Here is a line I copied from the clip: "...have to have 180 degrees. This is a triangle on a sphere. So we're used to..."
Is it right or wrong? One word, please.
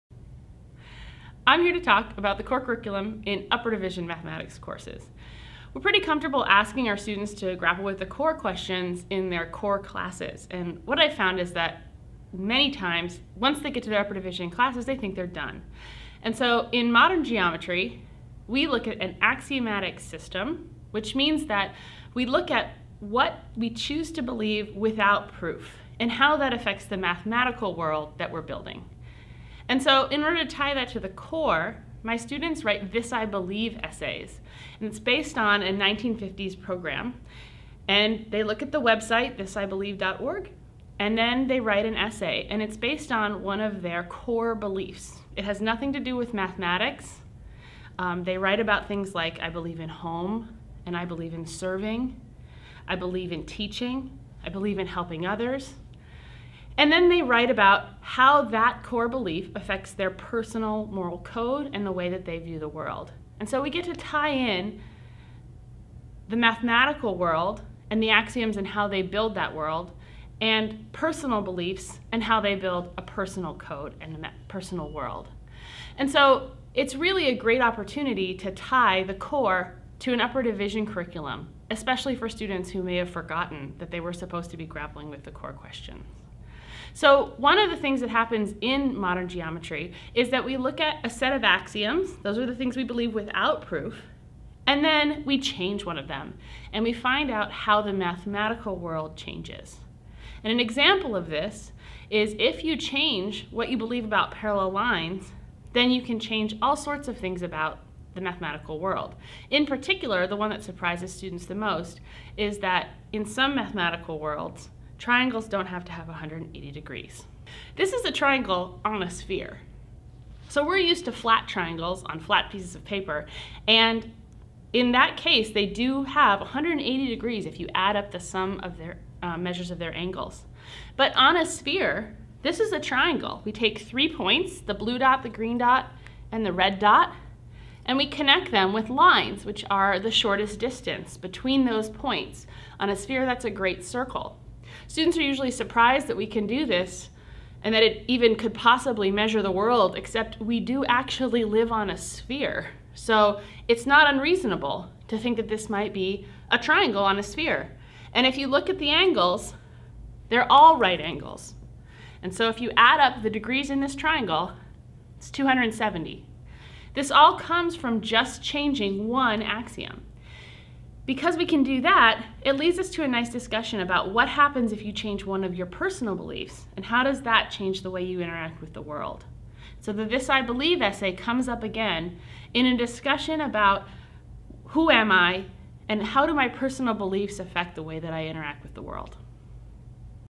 right.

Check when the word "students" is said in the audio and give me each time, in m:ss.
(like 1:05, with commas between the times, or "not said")
0:06, 0:32, 1:22, 1:51, 2:24.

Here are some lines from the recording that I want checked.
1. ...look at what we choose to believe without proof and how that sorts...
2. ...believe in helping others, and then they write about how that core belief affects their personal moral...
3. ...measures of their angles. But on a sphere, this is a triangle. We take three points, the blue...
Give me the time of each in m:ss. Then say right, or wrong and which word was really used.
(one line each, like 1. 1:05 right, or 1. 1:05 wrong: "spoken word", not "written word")
1. 0:22 wrong: "affects", not "sorts"
2. 0:54 right
3. 2:09 right.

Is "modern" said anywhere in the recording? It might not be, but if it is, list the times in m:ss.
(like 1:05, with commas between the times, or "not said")
0:16, 1:28.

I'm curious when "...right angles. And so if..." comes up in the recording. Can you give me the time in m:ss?
2:40.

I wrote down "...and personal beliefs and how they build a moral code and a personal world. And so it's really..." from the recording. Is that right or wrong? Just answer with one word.
wrong.